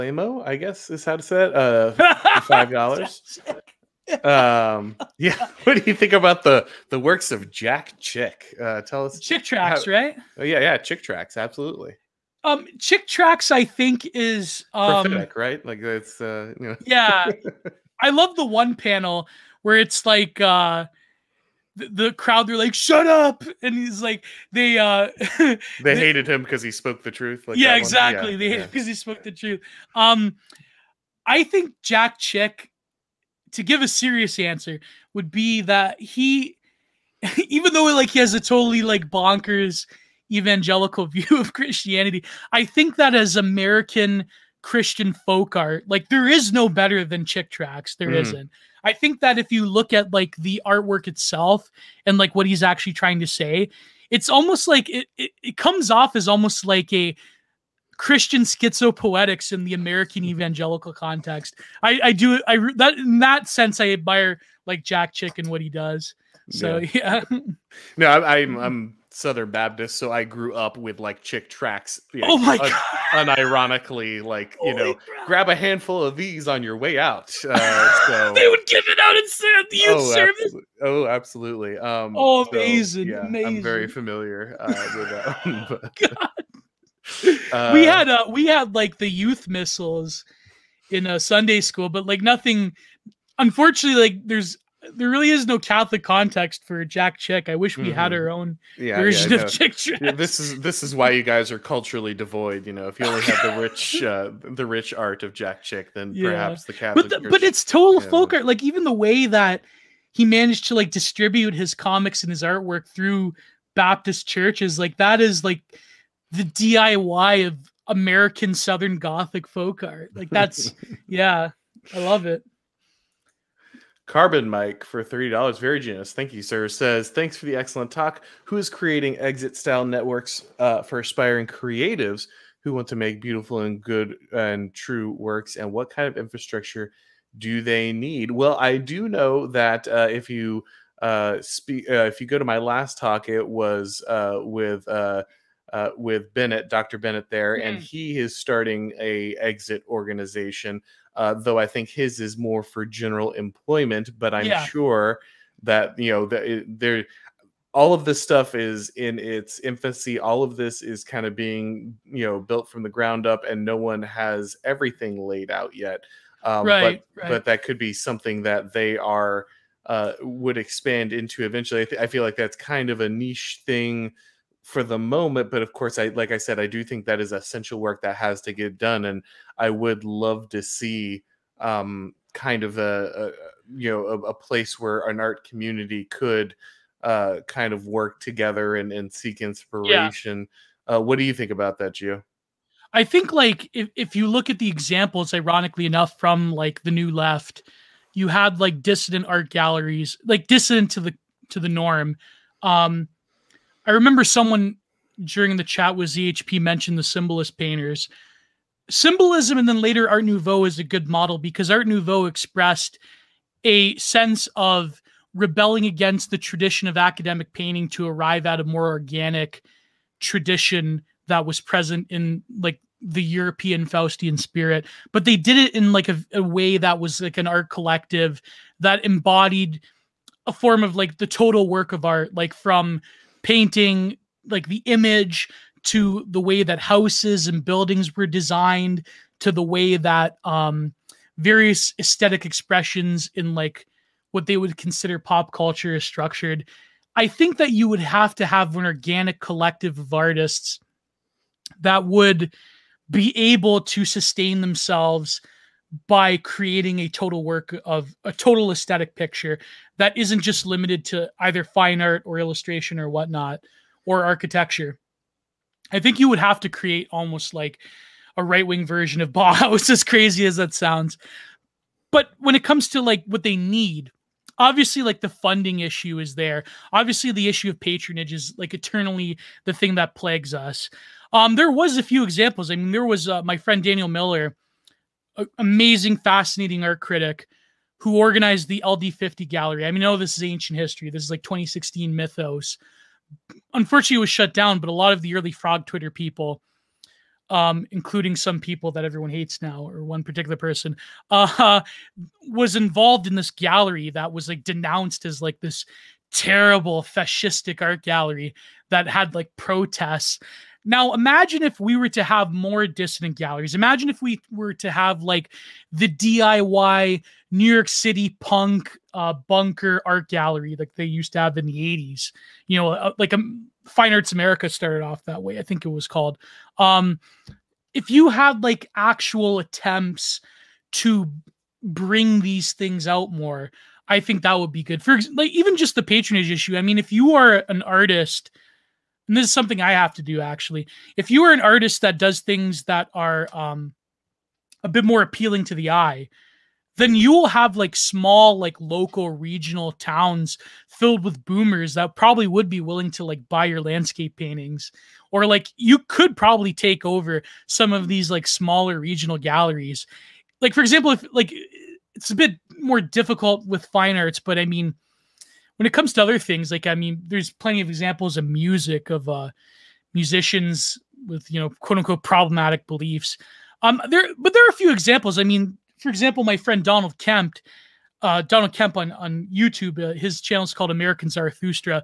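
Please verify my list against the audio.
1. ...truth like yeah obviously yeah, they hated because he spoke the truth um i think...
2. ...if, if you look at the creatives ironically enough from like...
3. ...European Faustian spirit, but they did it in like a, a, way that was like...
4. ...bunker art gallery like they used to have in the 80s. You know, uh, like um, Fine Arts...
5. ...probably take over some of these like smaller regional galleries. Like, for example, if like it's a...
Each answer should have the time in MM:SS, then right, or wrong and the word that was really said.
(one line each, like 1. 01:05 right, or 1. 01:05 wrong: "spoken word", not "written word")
1. 00:27 wrong: "exactly", not "obviously"
2. 03:13 wrong: "examples", not "creatives"
3. 03:43 right
4. 05:19 right
5. 05:56 right.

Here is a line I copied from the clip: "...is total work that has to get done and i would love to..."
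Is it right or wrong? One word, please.
wrong.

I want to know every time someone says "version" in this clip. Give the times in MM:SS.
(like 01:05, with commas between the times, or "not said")
01:38, 04:28.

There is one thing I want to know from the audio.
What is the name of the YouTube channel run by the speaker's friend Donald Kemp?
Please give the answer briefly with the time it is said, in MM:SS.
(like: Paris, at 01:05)
American Zarathustra, at 06:20.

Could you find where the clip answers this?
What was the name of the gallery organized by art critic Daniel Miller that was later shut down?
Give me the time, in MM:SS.
04:48.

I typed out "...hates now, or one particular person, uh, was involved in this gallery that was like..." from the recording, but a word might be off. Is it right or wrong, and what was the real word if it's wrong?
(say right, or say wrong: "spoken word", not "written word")
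right.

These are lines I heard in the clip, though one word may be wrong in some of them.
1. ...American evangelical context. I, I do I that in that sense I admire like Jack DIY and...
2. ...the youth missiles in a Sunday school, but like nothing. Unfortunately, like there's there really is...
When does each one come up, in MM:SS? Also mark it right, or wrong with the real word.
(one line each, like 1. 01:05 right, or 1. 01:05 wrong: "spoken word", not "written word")
1. 00:59 wrong: "Chick", not "DIY"
2. 01:28 right.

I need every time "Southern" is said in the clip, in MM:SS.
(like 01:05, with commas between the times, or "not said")
01:09, 01:58.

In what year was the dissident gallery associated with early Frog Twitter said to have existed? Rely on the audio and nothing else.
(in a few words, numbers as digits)
2016.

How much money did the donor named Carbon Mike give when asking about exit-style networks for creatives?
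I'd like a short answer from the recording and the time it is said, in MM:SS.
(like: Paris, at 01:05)
$30, at 02:05.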